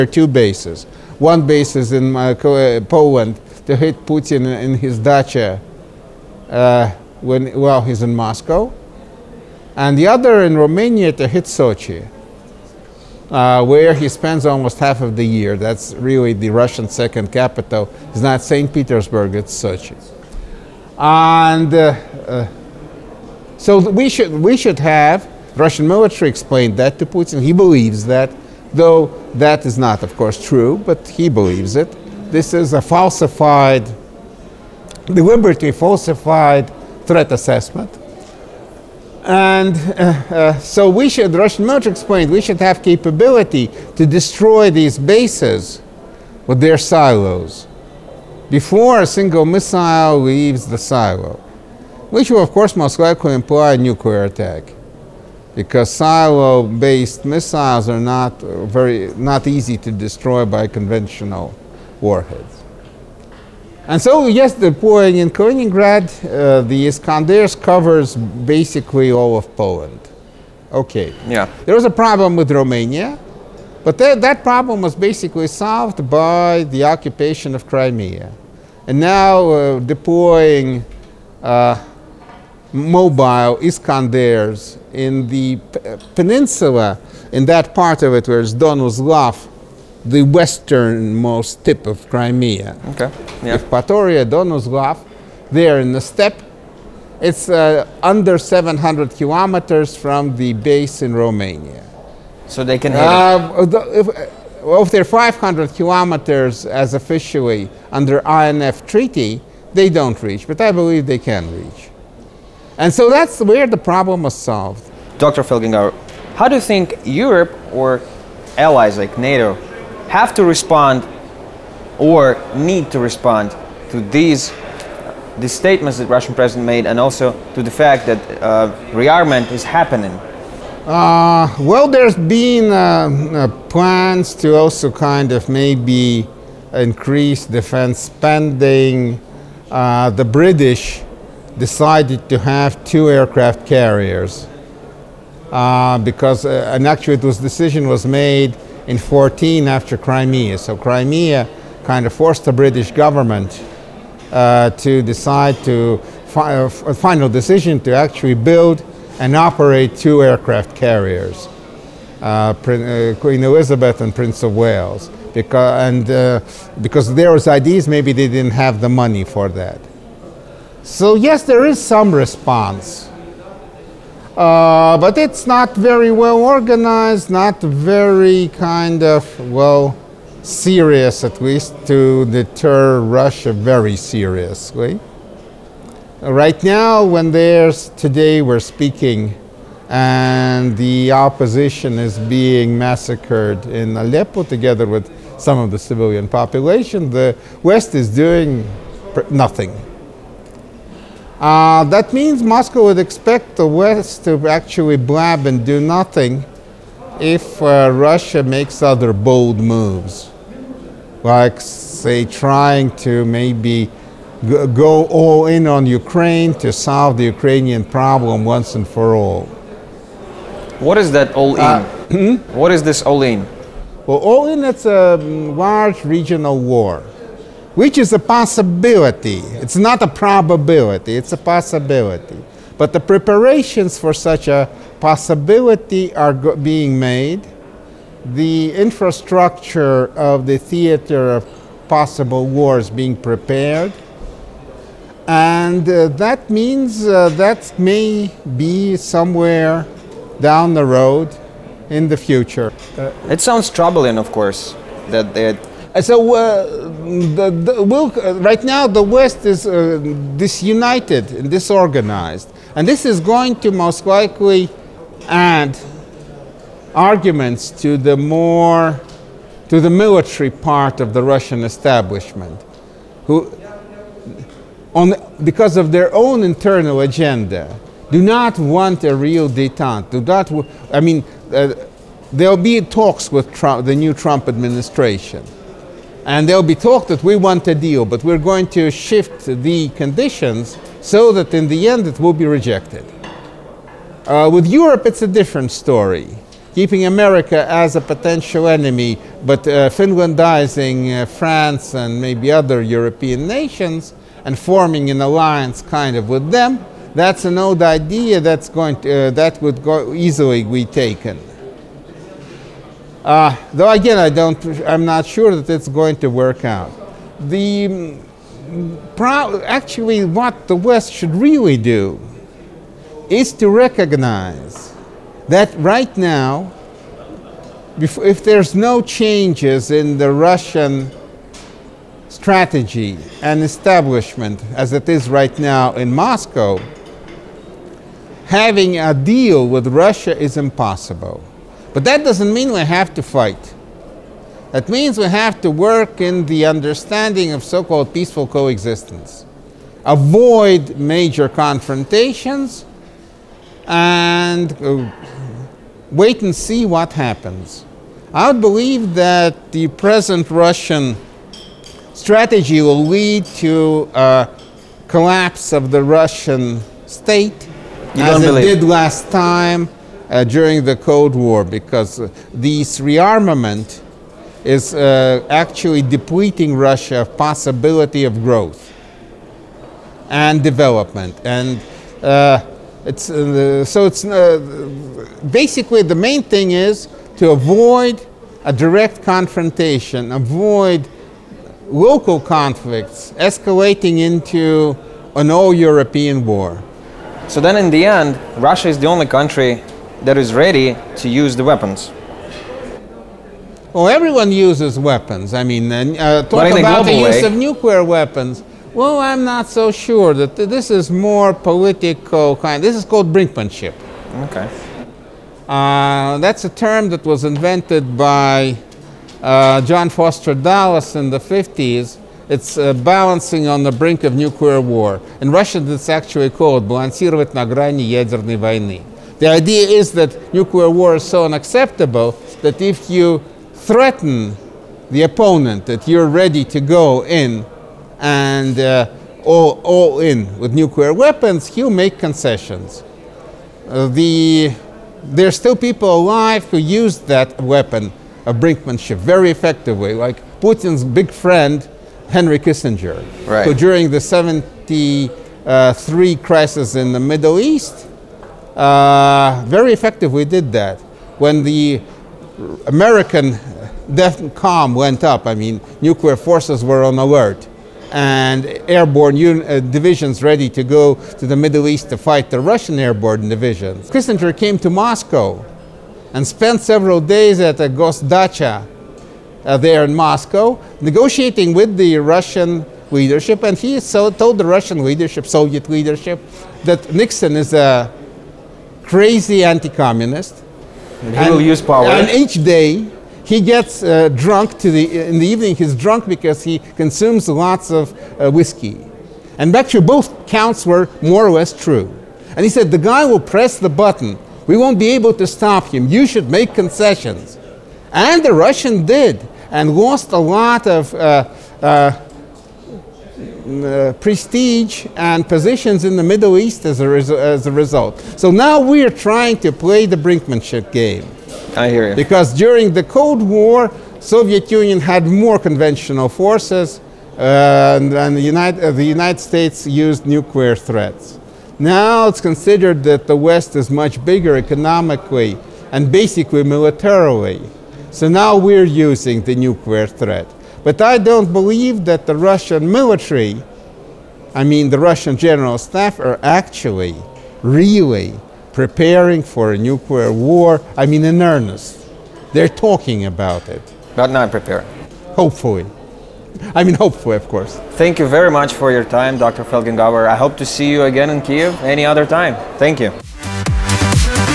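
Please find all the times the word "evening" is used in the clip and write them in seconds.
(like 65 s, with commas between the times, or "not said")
495 s.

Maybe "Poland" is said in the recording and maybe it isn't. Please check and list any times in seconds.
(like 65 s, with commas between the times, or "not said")
2 s, 69 s.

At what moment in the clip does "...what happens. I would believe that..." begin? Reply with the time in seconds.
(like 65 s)
356 s.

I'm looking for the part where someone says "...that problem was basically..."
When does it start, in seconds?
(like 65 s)
74 s.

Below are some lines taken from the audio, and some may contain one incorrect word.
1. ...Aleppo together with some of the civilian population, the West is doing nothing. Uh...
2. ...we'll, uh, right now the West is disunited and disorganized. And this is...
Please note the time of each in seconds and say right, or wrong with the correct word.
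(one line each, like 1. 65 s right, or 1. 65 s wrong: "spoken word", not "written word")
1. 193 s right
2. 257 s right.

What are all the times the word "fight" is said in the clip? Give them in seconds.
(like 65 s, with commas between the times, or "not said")
343 s, 472 s.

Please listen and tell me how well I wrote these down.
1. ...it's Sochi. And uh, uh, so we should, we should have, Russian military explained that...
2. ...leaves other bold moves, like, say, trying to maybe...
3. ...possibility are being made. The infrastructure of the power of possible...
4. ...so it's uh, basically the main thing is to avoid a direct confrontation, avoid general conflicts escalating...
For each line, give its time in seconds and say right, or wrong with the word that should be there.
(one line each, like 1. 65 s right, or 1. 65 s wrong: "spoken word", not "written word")
1. 19 s right
2. 208 s wrong: "makes", not "leaves"
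3. 234 s wrong: "theater", not "power"
4. 383 s wrong: "local", not "general".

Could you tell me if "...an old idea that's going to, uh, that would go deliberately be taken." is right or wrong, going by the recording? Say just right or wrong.
wrong.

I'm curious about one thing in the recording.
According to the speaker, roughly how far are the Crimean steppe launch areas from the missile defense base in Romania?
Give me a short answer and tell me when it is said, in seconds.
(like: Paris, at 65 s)
under 700 kilometers, at 98 s.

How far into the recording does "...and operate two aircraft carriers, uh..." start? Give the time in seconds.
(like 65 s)
159 s.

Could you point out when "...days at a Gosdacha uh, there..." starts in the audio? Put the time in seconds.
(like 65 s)
477 s.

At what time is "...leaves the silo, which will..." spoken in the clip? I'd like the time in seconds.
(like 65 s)
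50 s.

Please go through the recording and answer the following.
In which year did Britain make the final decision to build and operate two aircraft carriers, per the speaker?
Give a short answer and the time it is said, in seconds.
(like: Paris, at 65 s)
2014, at 148 s.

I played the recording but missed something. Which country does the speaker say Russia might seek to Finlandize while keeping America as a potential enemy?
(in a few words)
France.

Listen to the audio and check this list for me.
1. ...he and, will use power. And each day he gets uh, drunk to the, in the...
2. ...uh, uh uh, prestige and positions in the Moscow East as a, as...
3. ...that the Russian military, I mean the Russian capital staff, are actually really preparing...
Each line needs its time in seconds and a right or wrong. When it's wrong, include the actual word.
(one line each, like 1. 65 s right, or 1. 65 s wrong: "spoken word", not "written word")
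1. 491 s right
2. 511 s wrong: "Middle", not "Moscow"
3. 542 s wrong: "general", not "capital".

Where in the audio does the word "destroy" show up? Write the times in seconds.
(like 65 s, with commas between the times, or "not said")
44 s, 59 s.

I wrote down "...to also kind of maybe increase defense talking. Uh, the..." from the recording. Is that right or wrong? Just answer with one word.
wrong.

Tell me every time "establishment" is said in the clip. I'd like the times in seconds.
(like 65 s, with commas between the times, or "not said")
271 s, 333 s.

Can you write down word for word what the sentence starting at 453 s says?
who during the 73 uh, crisis in the Middle East uh, very effective, we did that.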